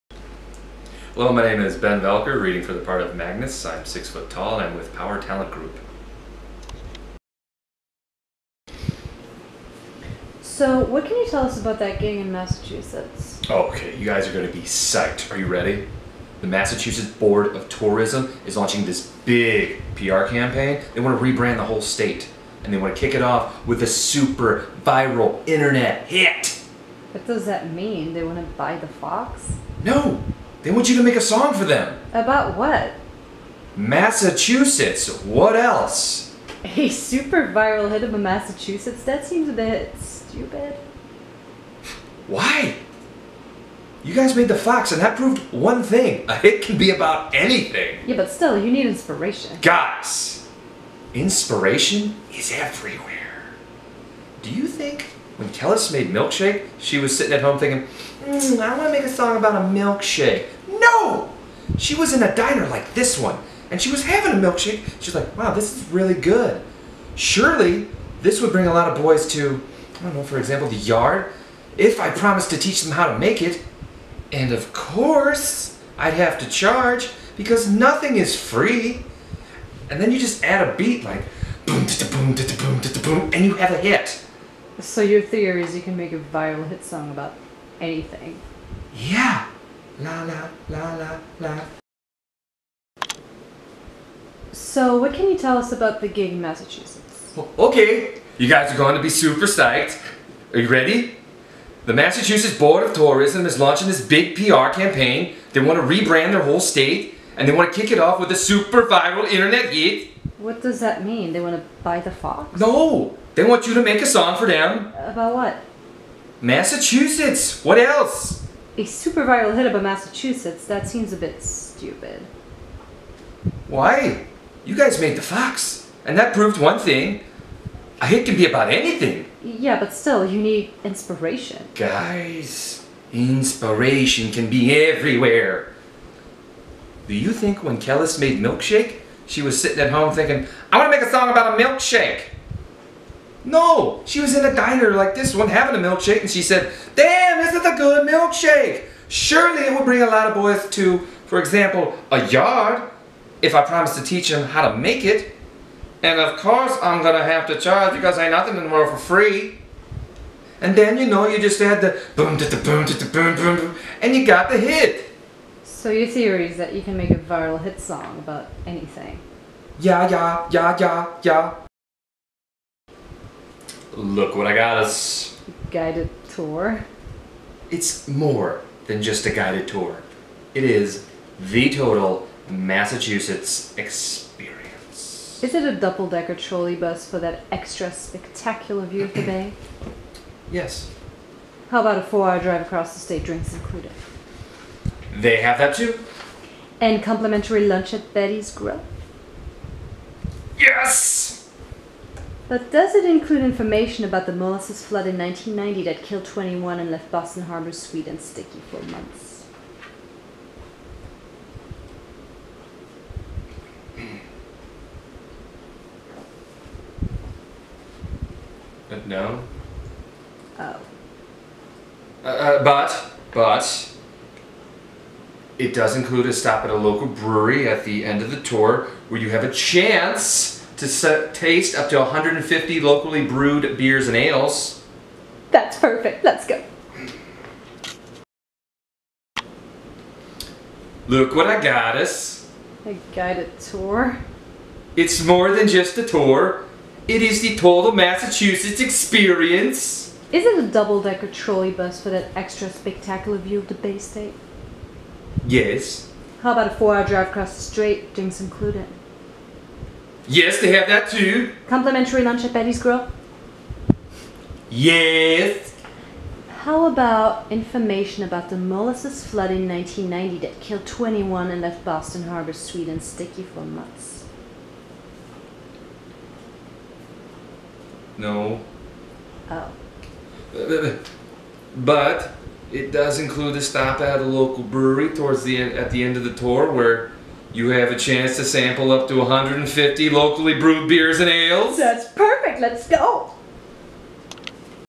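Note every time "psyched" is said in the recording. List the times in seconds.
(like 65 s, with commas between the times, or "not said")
14 s, 99 s.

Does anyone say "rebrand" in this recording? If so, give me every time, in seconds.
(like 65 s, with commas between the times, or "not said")
21 s, 105 s.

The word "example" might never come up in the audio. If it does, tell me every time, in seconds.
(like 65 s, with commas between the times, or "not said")
70 s, 151 s.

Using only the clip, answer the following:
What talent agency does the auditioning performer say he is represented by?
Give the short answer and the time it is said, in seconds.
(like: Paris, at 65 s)
Power Talent Group, at 4 s.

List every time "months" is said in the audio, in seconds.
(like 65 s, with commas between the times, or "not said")
208 s, 273 s.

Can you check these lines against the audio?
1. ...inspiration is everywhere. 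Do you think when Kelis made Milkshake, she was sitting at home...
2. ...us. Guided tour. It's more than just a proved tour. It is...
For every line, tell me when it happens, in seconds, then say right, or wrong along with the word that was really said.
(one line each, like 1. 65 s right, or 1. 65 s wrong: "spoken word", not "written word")
1. 51 s right
2. 174 s wrong: "guided", not "proved".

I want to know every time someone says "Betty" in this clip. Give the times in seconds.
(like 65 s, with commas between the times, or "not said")
198 s, 262 s.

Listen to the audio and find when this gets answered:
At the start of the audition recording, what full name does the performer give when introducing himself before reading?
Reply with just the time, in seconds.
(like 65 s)
1 s.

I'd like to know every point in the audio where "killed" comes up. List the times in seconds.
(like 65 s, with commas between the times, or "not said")
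206 s, 270 s.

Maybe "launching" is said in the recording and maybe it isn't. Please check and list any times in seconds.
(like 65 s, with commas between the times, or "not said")
18 s, 103 s.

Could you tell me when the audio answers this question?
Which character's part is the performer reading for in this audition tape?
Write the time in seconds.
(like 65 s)
3 s.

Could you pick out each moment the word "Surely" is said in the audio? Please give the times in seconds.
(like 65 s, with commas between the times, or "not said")
67 s, 149 s.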